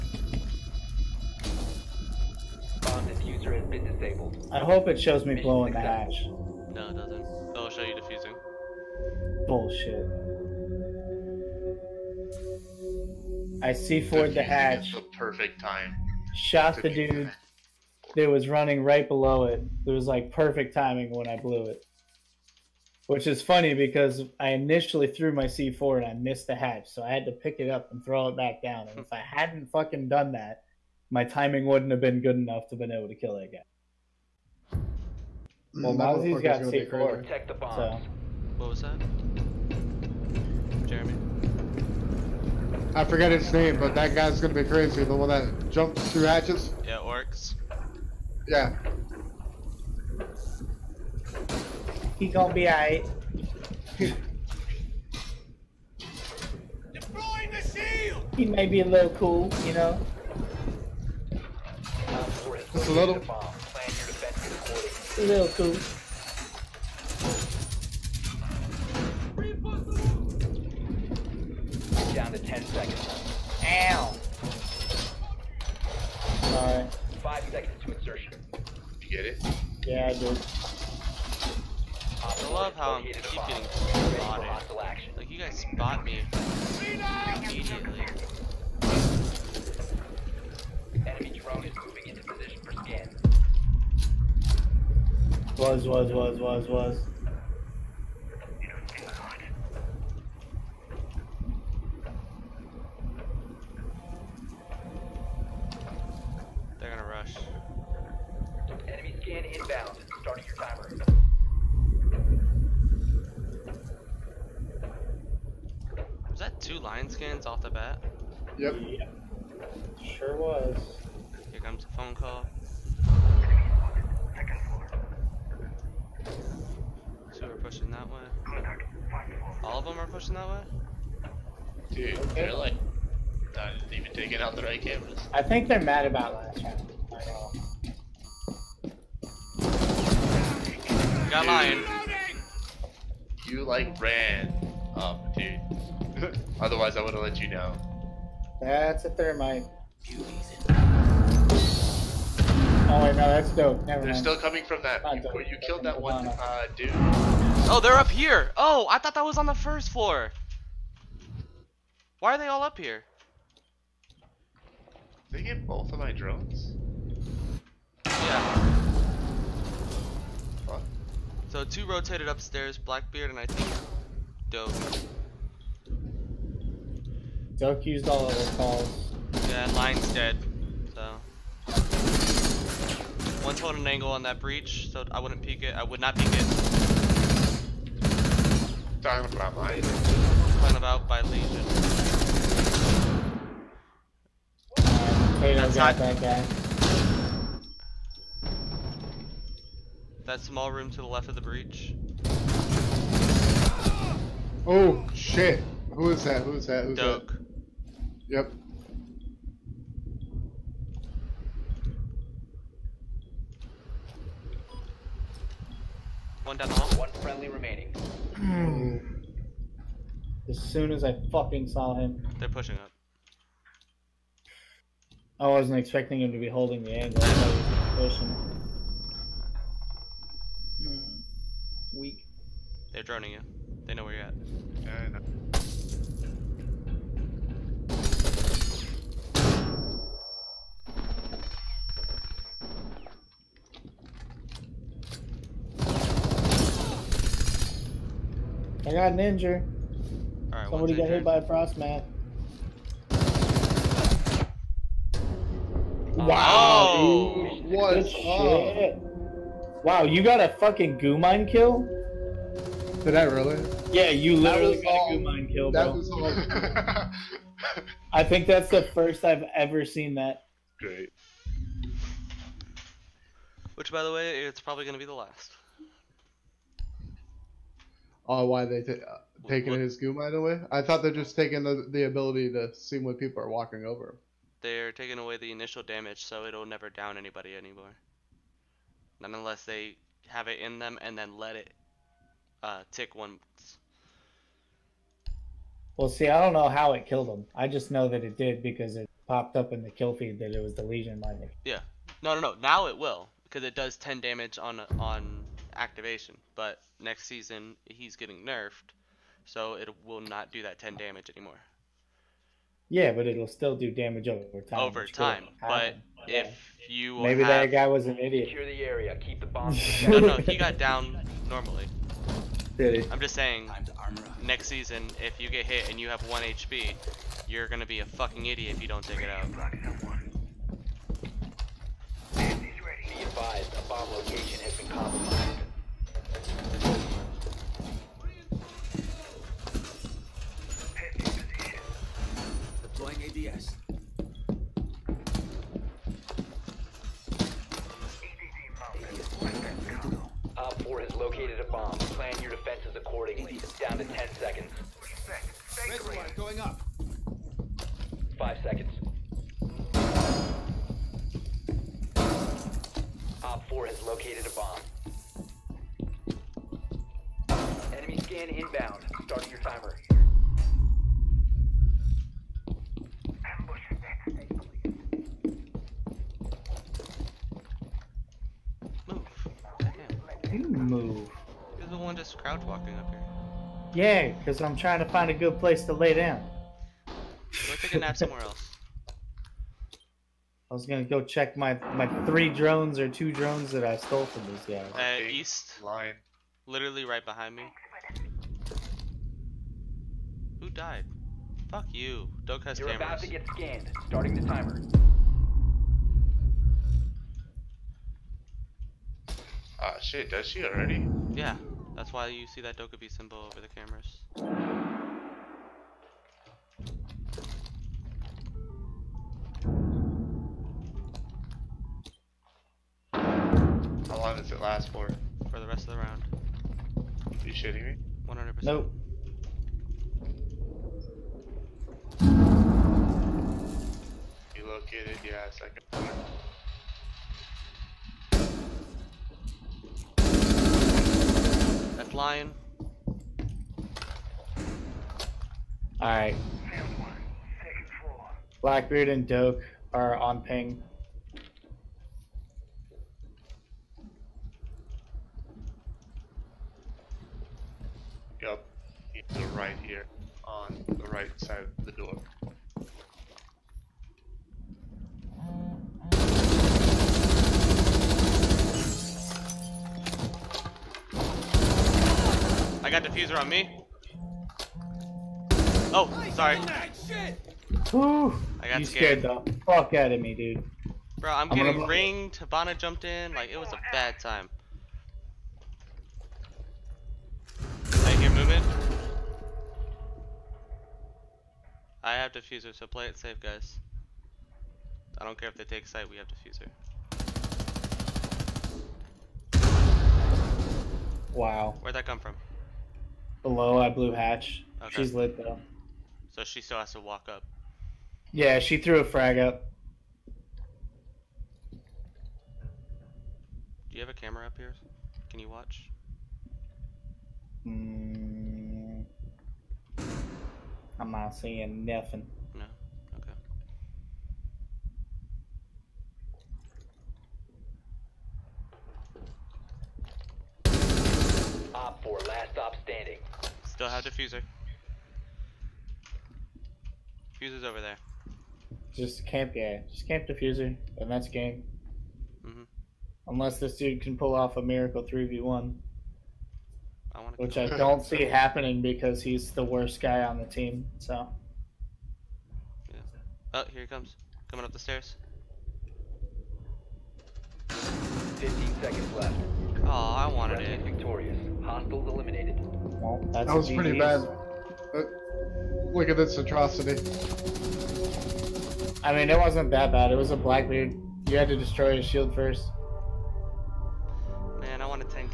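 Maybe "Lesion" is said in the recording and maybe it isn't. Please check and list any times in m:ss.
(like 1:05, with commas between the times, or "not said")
3:11, 5:00.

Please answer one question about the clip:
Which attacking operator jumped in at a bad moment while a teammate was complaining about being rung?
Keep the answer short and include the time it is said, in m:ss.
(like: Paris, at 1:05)
Havana, at 8:02.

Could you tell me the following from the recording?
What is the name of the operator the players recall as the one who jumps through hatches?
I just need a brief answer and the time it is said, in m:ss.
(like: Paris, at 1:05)
Oryx, at 0:46.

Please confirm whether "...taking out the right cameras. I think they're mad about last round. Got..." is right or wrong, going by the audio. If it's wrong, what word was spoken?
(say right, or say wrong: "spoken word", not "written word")
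right.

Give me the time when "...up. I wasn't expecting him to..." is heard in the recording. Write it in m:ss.
3:42.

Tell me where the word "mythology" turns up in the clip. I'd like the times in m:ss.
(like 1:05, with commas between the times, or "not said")
not said.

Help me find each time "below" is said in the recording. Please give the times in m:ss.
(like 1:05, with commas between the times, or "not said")
0:19, 8:23.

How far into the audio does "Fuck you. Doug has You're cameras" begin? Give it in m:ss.
6:41.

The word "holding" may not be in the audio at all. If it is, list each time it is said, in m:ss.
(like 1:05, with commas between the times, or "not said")
3:03, 3:46.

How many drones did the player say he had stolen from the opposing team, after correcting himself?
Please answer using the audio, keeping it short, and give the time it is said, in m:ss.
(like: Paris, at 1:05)
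2, at 6:33.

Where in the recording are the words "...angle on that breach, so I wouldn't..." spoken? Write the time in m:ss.
3:03.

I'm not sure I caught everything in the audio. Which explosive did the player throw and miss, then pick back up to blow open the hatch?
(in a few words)
C4.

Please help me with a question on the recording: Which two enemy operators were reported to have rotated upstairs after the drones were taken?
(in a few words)
Blackbeard and Doke.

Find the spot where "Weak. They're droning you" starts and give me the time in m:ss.
3:51.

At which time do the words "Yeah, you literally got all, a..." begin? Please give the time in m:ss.
4:23.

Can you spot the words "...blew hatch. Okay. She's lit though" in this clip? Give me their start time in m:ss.
8:23.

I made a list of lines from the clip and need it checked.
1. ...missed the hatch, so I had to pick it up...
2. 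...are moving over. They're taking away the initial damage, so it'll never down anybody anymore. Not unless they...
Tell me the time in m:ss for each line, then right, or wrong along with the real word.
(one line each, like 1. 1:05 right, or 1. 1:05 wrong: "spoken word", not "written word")
1. 0:26 right
2. 4:43 wrong: "walking", not "moving".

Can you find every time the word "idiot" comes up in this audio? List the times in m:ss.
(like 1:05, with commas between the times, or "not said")
5:18, 5:28.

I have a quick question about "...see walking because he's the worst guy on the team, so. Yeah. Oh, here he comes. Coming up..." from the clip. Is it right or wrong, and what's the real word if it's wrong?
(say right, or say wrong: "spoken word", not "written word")
wrong: "happening", not "walking".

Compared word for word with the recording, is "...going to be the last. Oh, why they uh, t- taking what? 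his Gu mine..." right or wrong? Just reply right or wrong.
right.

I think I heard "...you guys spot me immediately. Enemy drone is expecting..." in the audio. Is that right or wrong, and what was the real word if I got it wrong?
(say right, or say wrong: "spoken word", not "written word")
wrong: "moving", not "expecting".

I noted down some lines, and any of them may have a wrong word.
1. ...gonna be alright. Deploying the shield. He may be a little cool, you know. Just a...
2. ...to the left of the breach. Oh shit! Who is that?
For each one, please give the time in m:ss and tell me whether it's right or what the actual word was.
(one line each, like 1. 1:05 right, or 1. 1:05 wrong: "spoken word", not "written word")
1. 0:52 right
2. 3:20 right.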